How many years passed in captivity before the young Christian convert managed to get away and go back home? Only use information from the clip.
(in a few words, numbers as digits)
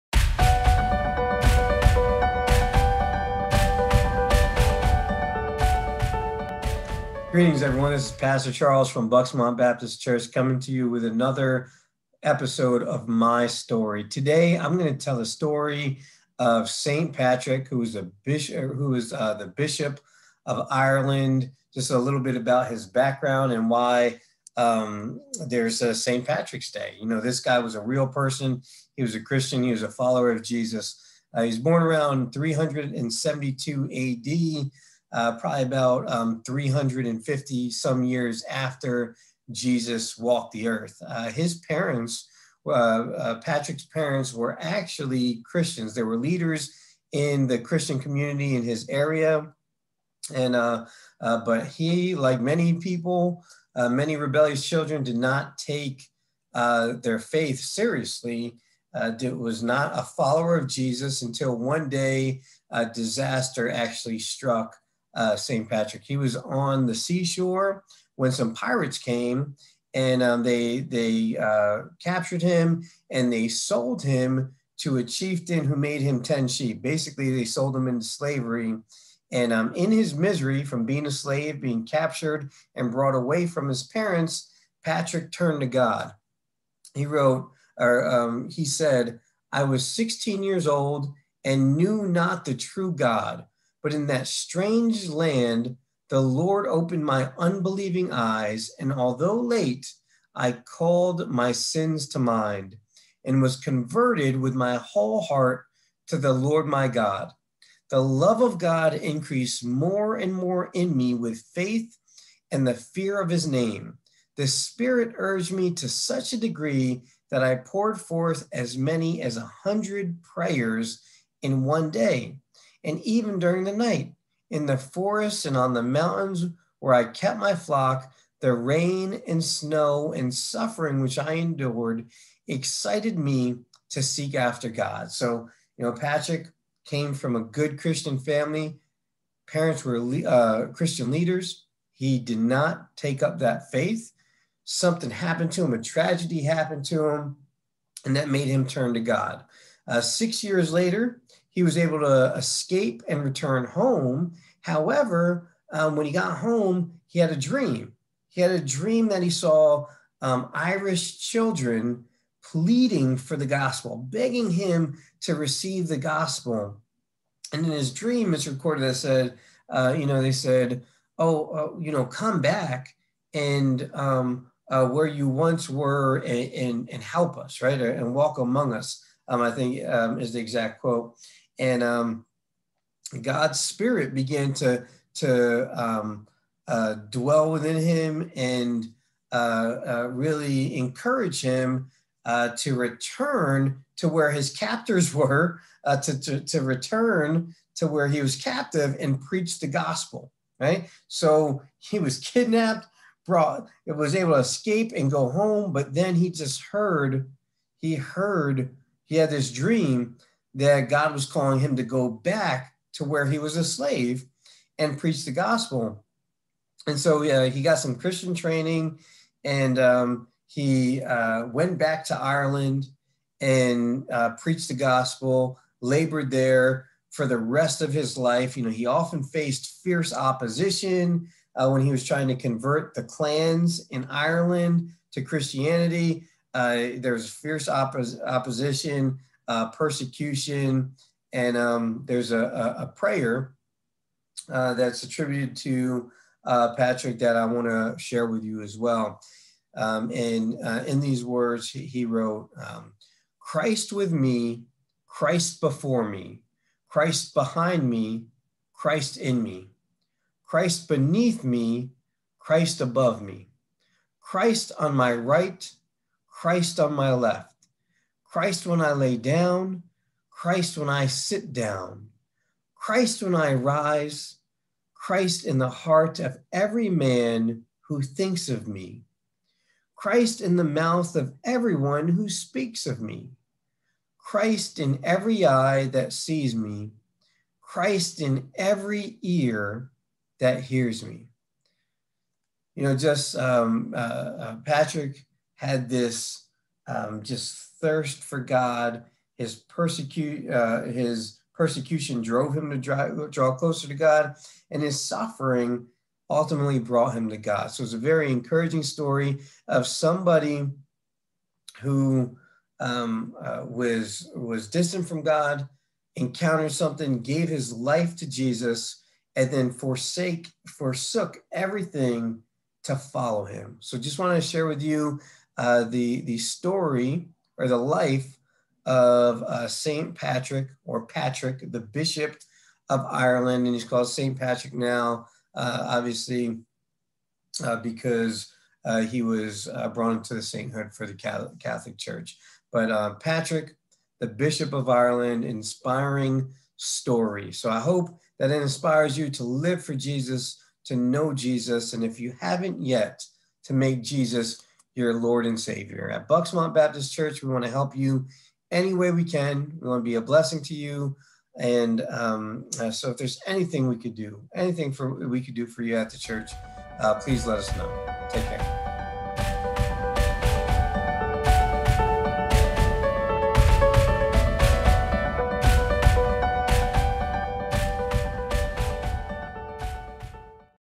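6.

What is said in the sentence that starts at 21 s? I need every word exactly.
Just a little bit about his background and why um, there's a St.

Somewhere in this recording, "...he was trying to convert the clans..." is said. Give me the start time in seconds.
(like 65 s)
231 s.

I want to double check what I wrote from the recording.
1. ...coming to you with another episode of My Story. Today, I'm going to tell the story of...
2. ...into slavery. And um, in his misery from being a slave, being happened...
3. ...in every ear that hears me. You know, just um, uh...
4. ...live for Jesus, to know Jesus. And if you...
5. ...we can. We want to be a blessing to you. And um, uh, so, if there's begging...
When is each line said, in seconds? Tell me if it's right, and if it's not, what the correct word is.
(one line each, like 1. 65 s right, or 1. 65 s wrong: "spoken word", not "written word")
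1. 10 s right
2. 77 s wrong: "captured", not "happened"
3. 288 s right
4. 349 s right
5. 359 s wrong: "anything", not "begging".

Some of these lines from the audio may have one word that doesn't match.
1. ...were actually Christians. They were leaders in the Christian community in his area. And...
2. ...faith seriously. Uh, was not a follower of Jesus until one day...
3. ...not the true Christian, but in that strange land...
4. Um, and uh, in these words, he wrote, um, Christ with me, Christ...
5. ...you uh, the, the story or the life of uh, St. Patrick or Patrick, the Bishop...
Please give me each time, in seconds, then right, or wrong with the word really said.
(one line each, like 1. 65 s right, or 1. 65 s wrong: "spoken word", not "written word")
1. 44 s right
2. 57 s right
3. 92 s wrong: "God", not "Christian"
4. 249 s right
5. 324 s right.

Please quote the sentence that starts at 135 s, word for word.
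So, you know, Patrick came from a good Christian family.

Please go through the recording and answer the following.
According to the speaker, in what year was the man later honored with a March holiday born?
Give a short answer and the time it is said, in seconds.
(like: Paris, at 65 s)
372 AD, at 32 s.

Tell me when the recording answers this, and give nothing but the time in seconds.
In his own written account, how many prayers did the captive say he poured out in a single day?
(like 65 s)
119 s.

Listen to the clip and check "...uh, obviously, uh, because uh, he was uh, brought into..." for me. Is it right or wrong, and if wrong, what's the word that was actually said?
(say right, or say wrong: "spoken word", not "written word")
right.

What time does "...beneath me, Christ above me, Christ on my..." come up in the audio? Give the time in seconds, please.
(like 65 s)
260 s.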